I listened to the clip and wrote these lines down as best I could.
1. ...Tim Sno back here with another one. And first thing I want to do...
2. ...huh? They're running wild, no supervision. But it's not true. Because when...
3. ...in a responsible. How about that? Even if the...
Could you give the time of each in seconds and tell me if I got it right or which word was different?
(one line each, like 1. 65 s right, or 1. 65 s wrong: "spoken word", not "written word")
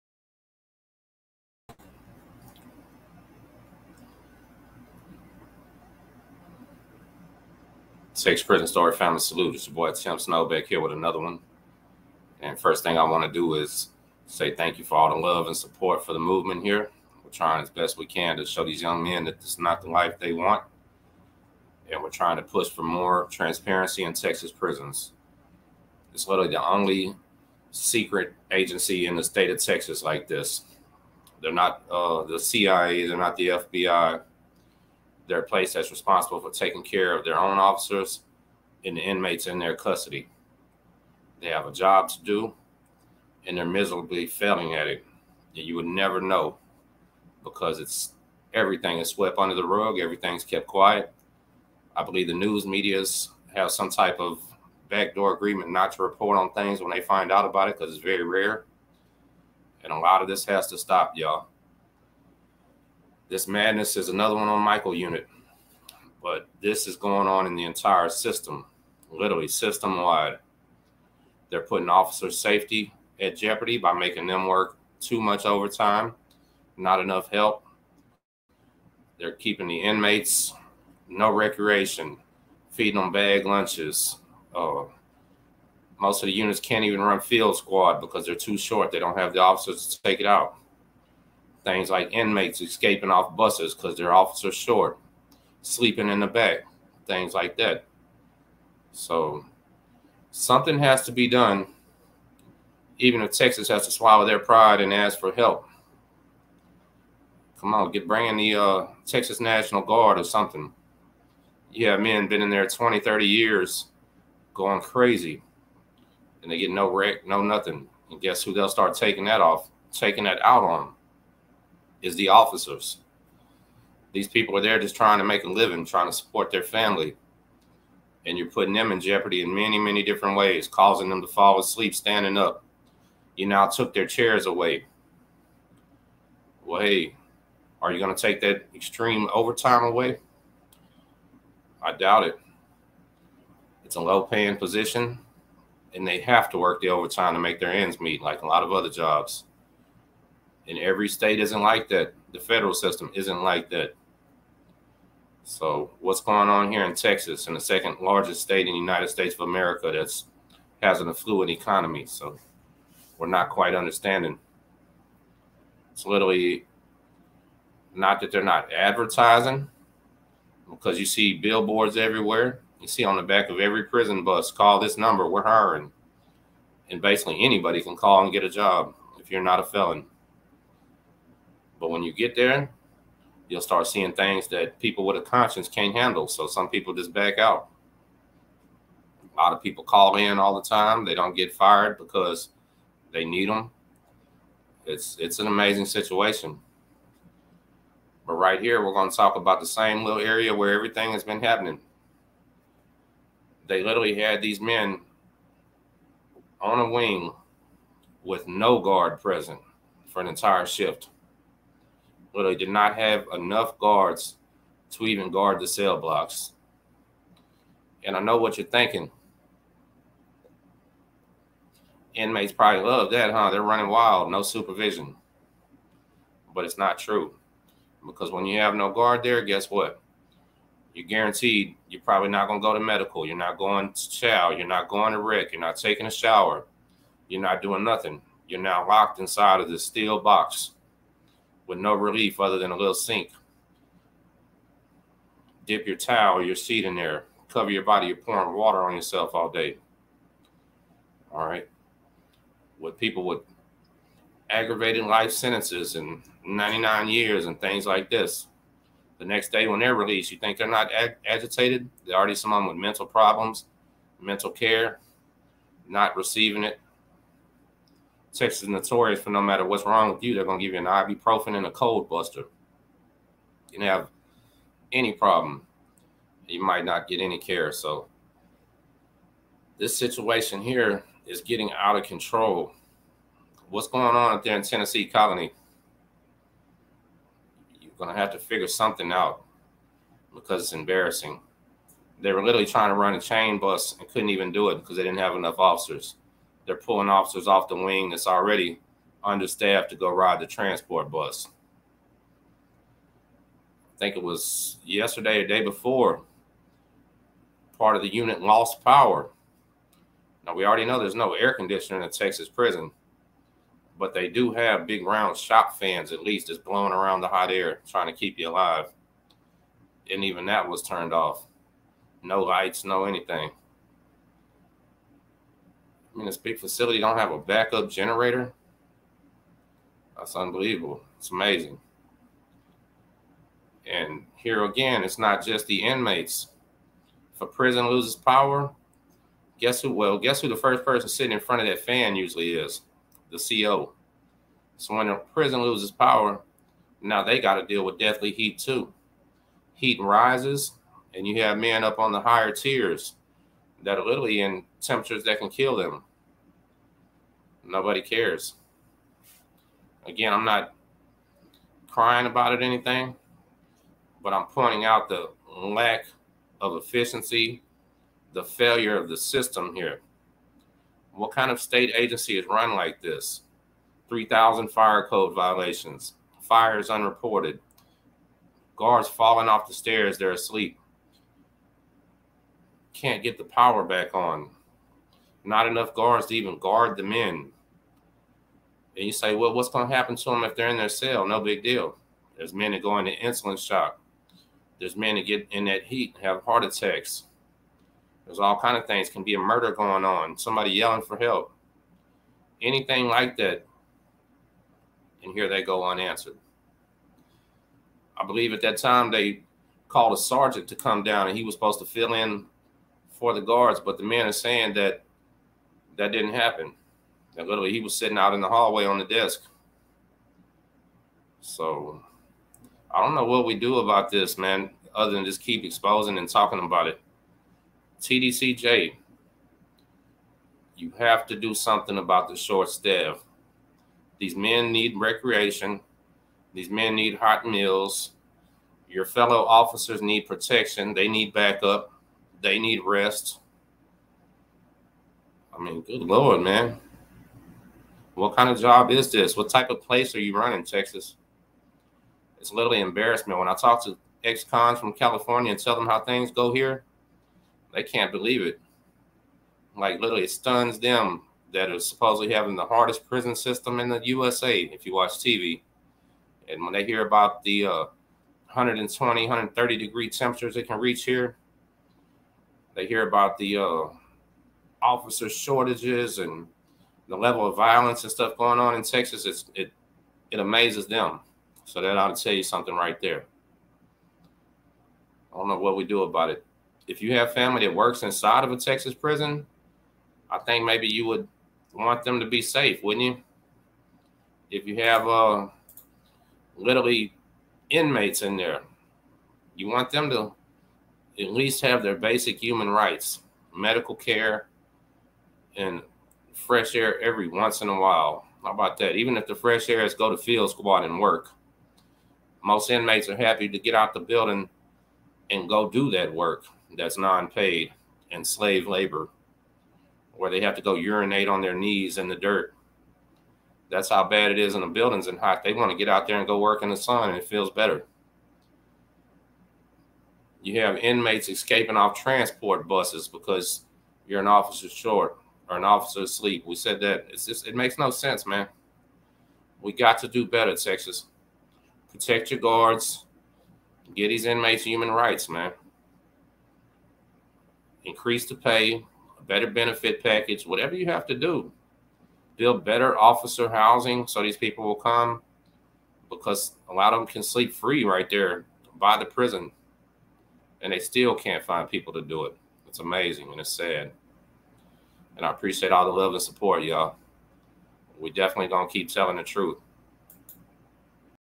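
1. 9 s right
2. 223 s right
3. 507 s wrong: "while", not "responsible".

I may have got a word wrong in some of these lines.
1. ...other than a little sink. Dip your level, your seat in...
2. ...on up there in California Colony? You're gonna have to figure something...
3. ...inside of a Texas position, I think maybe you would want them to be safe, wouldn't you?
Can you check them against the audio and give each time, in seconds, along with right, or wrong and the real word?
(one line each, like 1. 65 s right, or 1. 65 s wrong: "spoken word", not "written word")
1. 242 s wrong: "towel", not "level"
2. 284 s wrong: "Tennessee", not "California"
3. 488 s wrong: "prison", not "position".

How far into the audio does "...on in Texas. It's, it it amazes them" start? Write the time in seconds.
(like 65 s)
478 s.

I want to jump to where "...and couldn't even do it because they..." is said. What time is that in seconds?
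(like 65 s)
293 s.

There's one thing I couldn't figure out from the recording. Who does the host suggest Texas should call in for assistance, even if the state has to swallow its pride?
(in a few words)
Texas National Guard.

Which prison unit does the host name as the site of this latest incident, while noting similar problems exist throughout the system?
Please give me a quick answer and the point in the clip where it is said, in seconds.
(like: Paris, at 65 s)
Michael unit, at 64 s.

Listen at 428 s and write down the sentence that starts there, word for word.
TDCJ, you have to do something about the short staff.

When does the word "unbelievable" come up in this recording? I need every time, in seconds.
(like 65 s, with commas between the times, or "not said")
330 s.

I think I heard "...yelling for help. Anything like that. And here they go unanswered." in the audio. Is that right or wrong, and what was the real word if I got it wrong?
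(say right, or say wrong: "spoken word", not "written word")
right.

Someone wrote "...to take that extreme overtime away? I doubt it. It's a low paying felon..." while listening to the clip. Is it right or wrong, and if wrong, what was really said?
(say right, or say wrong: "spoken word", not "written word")
wrong: "position", not "felon".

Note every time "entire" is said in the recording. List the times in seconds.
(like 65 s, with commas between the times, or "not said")
67 s, 210 s.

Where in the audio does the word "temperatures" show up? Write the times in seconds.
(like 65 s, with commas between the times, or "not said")
354 s, 470 s.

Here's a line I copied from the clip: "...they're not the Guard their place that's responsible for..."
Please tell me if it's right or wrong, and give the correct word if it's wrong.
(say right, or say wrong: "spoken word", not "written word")
wrong: "FBI", not "Guard".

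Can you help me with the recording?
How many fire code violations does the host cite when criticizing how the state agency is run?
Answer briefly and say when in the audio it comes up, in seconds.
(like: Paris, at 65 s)
3,000, at 374 s.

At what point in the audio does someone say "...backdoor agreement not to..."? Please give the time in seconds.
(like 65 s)
54 s.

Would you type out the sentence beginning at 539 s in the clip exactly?
We got to do better, Texas.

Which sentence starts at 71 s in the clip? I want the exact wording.
They're putting officer safety at jeopardy by making them work too much overtime, not enough help.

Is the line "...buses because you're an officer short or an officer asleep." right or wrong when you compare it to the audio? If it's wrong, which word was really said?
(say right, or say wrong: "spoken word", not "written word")
right.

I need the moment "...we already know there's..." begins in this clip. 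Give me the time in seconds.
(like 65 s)
310 s.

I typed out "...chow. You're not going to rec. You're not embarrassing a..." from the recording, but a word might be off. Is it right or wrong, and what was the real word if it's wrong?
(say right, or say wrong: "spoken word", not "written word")
wrong: "taking", not "embarrassing".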